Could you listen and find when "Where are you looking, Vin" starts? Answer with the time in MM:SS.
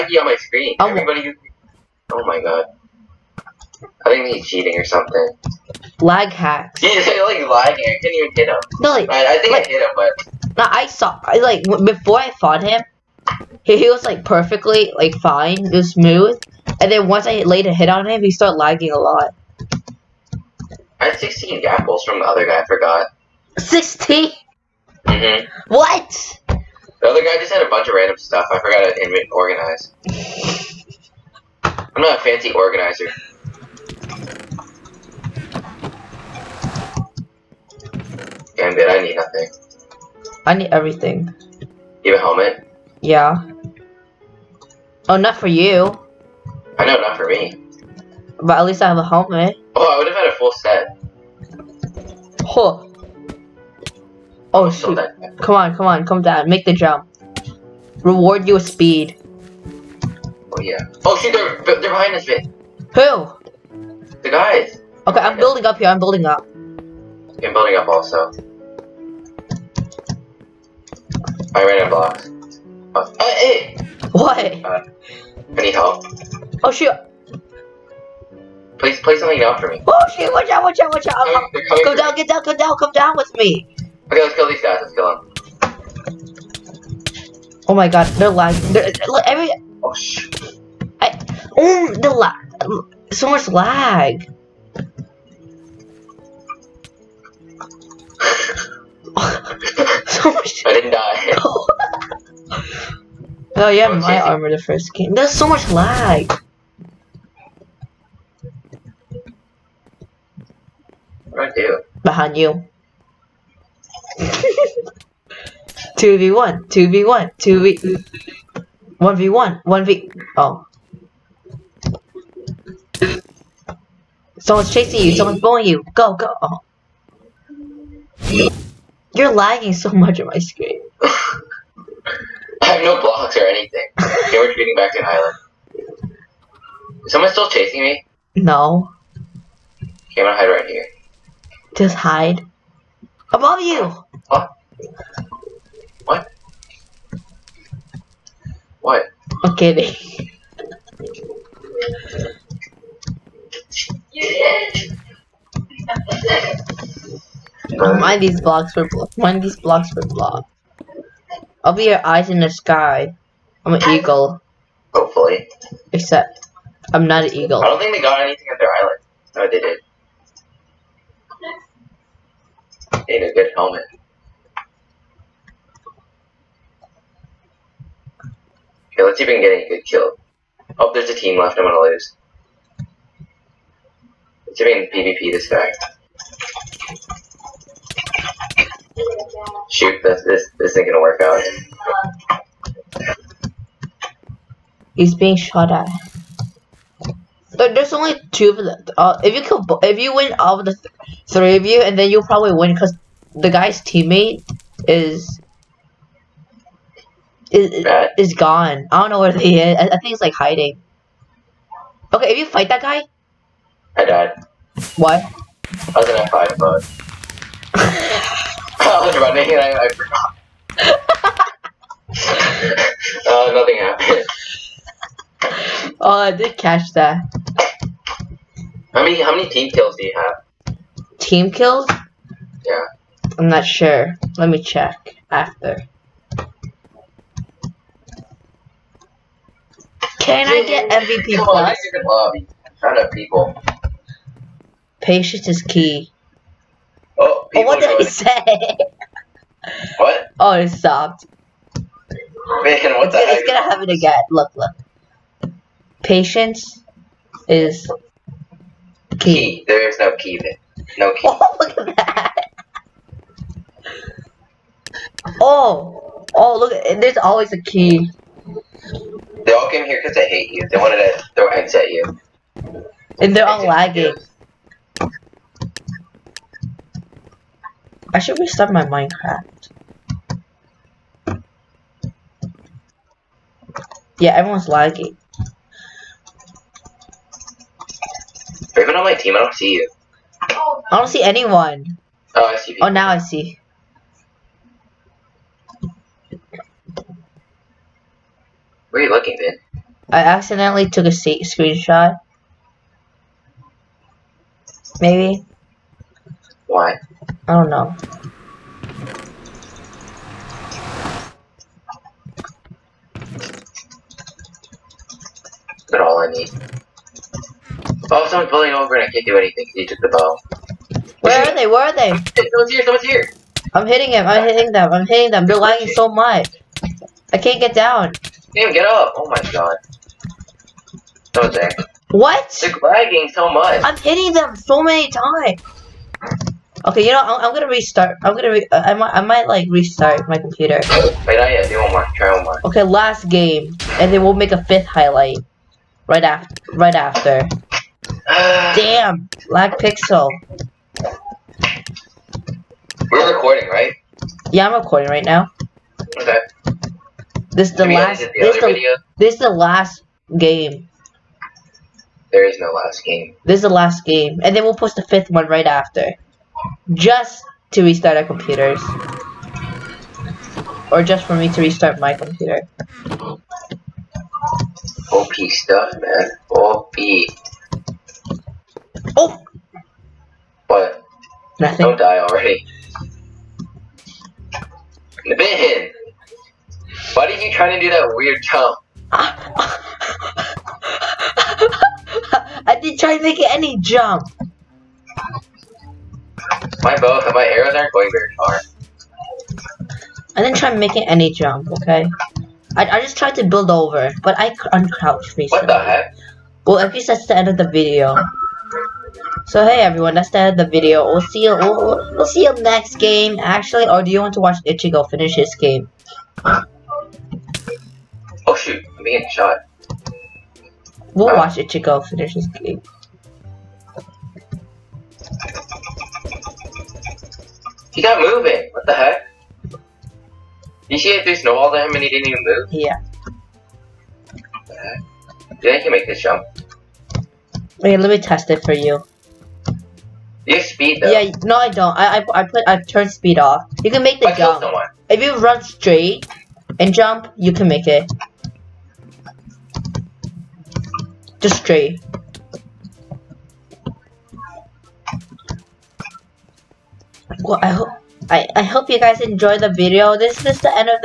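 04:58.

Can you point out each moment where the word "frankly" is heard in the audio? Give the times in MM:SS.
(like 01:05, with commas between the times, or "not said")
not said.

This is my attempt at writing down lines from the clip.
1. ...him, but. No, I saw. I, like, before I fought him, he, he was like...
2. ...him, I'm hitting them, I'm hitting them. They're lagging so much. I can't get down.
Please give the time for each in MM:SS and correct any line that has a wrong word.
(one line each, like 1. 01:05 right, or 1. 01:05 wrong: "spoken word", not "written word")
1. 00:09 right
2. 05:24 right.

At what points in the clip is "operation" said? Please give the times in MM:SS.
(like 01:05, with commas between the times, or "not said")
not said.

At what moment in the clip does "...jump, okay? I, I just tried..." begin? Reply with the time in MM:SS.
06:41.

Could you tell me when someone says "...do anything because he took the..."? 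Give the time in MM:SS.
05:19.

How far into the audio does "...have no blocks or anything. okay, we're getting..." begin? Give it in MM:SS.
02:12.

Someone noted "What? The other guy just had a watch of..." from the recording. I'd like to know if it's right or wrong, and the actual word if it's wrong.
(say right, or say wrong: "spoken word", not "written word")
wrong: "bunch", not "watch".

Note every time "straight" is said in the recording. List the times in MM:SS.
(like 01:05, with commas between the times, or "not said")
07:25, 07:31.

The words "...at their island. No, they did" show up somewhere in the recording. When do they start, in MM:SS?
02:48.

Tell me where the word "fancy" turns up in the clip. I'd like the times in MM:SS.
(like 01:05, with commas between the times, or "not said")
00:32.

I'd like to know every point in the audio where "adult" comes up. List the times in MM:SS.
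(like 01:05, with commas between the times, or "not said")
not said.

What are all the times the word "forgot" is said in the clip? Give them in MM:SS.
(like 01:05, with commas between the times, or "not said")
00:22, 00:28, 03:39.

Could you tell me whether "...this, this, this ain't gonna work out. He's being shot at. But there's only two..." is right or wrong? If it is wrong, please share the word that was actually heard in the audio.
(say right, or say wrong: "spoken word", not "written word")
right.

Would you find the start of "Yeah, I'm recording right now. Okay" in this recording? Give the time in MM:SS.
05:54.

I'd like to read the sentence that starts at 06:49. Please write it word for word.
So hey everyone, that's the end of the video.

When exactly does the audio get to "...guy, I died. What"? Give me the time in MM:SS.
03:32.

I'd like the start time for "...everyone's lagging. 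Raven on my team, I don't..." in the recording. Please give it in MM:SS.
04:44.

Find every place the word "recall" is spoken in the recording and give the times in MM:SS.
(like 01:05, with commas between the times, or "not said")
not said.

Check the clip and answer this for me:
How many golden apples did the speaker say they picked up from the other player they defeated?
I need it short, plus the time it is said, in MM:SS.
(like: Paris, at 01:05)
16, at 00:21.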